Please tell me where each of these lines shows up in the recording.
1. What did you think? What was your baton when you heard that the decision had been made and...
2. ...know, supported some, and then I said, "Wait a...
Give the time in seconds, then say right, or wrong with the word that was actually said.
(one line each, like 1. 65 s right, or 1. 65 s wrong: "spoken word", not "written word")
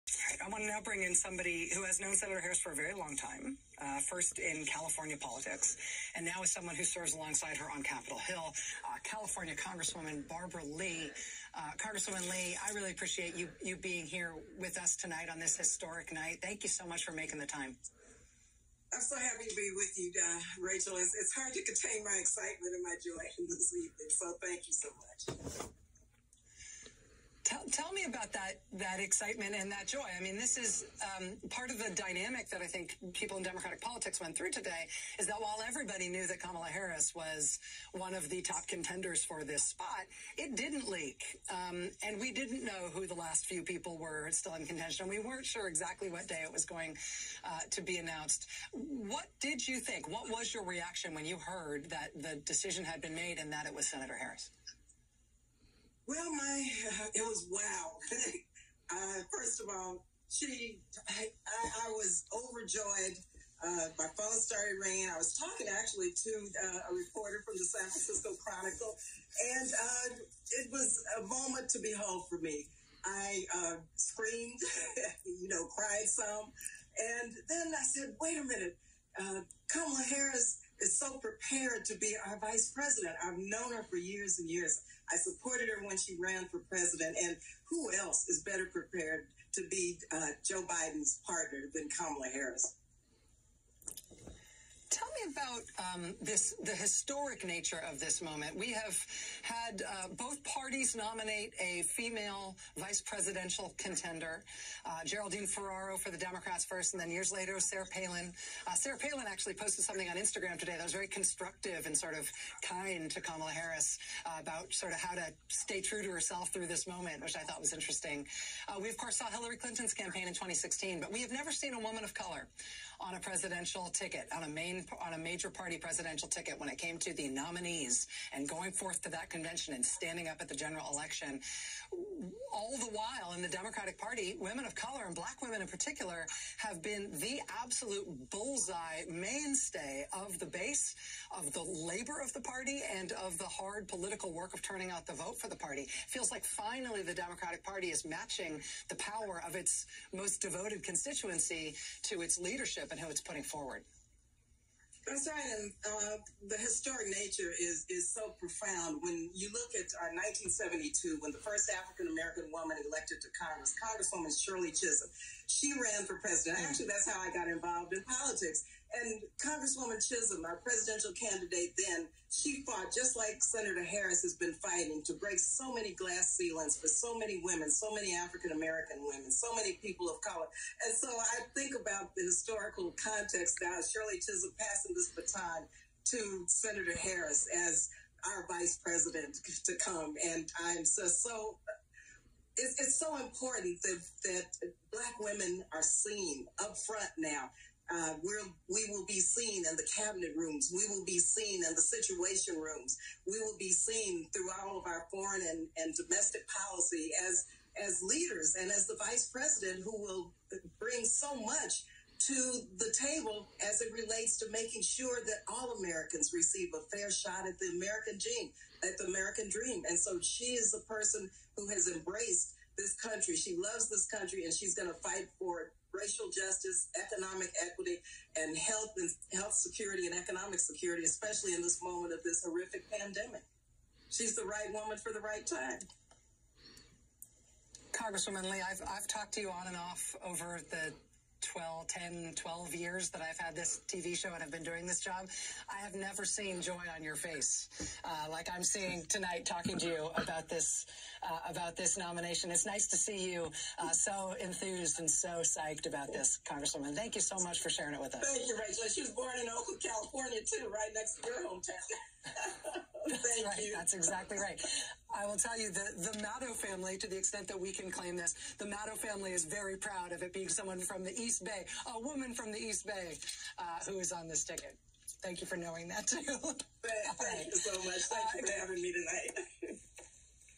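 1. 48 s wrong: "reaction", not "baton"
2. 75 s wrong: "cried", not "supported".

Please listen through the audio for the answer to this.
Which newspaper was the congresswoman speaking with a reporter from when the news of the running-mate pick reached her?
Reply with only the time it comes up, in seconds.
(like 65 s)
67 s.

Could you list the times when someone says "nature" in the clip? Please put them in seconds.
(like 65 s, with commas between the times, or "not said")
97 s, 157 s.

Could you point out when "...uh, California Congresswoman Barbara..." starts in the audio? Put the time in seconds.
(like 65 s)
8 s.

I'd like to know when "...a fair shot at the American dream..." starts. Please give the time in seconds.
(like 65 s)
216 s.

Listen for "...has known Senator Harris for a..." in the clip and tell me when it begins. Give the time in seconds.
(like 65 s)
1 s.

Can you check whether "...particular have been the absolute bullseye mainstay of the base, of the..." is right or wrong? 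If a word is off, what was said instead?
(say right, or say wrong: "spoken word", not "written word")
right.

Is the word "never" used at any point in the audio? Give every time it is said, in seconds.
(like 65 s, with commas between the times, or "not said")
121 s, 245 s.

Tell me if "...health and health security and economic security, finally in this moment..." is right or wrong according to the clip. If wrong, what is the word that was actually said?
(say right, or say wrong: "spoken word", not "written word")
wrong: "especially", not "finally".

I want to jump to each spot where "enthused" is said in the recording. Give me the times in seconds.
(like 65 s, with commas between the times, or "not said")
254 s.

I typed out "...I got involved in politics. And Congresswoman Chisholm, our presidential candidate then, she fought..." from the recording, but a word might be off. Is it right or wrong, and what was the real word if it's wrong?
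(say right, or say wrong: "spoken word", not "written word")
right.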